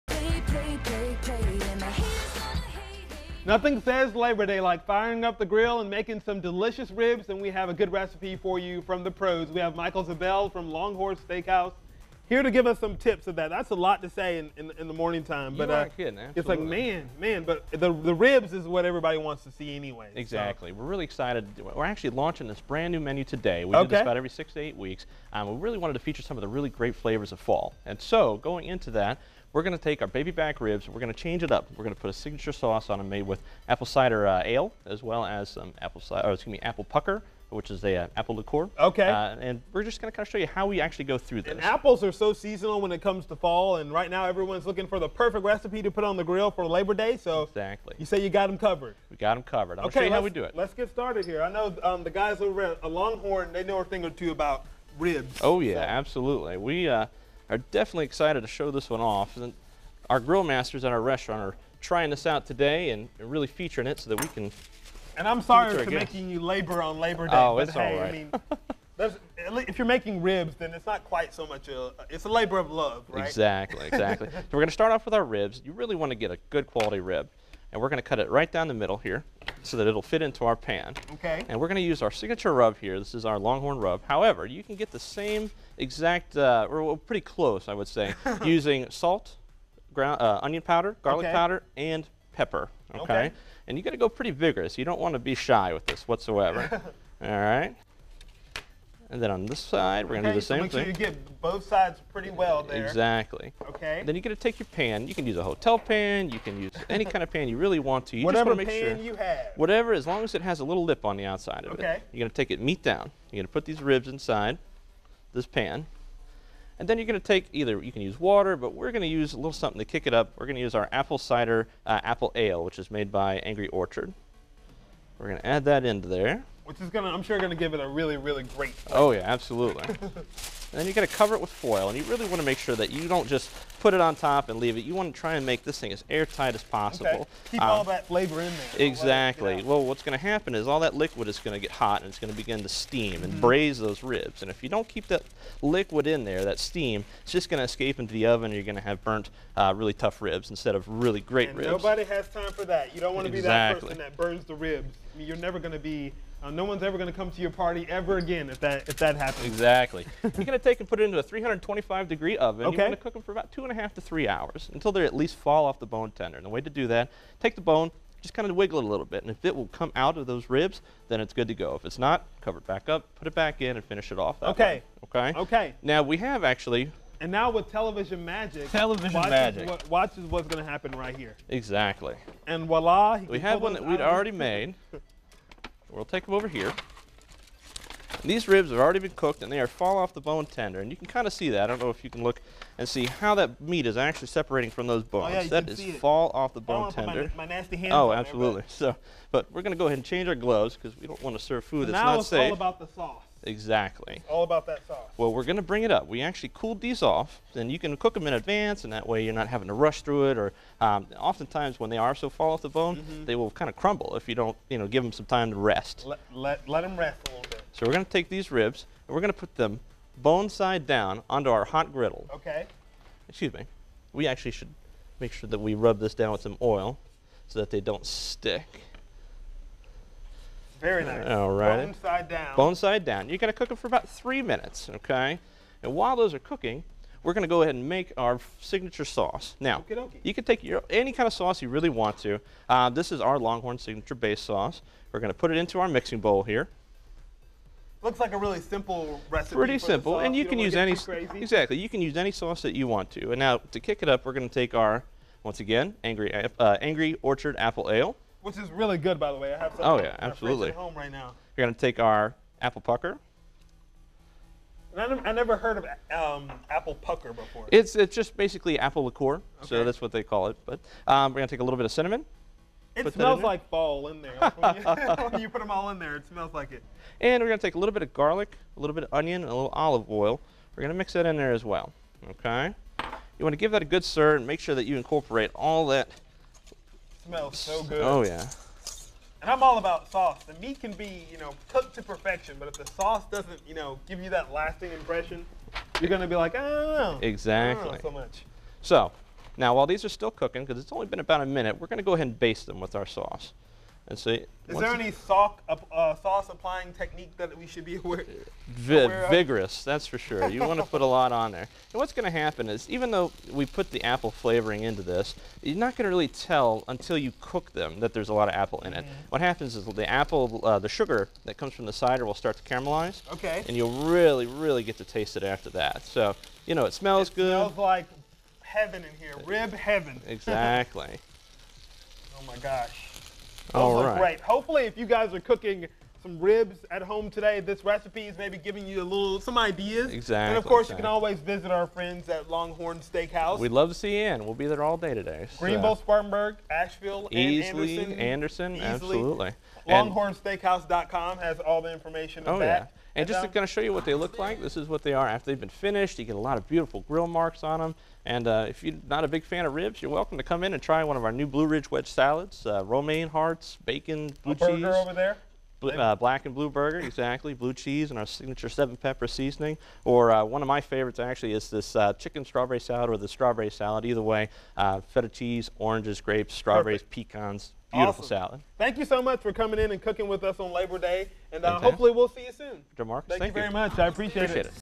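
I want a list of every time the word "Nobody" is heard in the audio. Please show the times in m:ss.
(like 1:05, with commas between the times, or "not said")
2:31.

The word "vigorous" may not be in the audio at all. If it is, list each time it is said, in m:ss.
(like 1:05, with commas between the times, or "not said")
1:34, 5:09.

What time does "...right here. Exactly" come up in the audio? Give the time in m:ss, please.
3:00.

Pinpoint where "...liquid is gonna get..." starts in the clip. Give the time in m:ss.
2:20.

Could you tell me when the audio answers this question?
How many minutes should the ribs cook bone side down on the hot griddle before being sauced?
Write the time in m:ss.
3:54.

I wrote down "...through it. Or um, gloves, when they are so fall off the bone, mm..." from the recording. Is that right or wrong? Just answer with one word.
wrong.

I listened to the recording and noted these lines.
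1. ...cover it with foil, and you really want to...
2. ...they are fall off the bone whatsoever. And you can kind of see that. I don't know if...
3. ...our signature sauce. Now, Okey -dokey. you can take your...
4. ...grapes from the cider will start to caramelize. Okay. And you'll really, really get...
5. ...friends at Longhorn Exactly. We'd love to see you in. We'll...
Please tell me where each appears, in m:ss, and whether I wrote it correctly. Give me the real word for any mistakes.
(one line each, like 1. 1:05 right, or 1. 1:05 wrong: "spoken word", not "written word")
1. 2:11 right
2. 3:09 wrong: "tender", not "whatsoever"
3. 3:58 right
4. 5:21 wrong: "comes", not "grapes"
5. 5:41 wrong: "Steakhouse", not "Exactly".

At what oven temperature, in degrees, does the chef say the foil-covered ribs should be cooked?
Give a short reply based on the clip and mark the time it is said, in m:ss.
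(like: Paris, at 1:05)
325, at 2:41.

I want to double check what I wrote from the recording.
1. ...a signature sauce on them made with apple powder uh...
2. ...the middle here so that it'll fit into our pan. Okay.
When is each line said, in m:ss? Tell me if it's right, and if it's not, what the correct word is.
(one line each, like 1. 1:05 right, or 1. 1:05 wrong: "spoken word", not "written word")
1. 0:32 wrong: "cider", not "powder"
2. 1:18 right.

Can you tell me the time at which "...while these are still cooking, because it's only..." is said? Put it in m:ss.
4:59.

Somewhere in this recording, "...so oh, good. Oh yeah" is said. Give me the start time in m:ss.
4:47.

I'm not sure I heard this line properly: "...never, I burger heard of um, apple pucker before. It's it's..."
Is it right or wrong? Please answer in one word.
wrong.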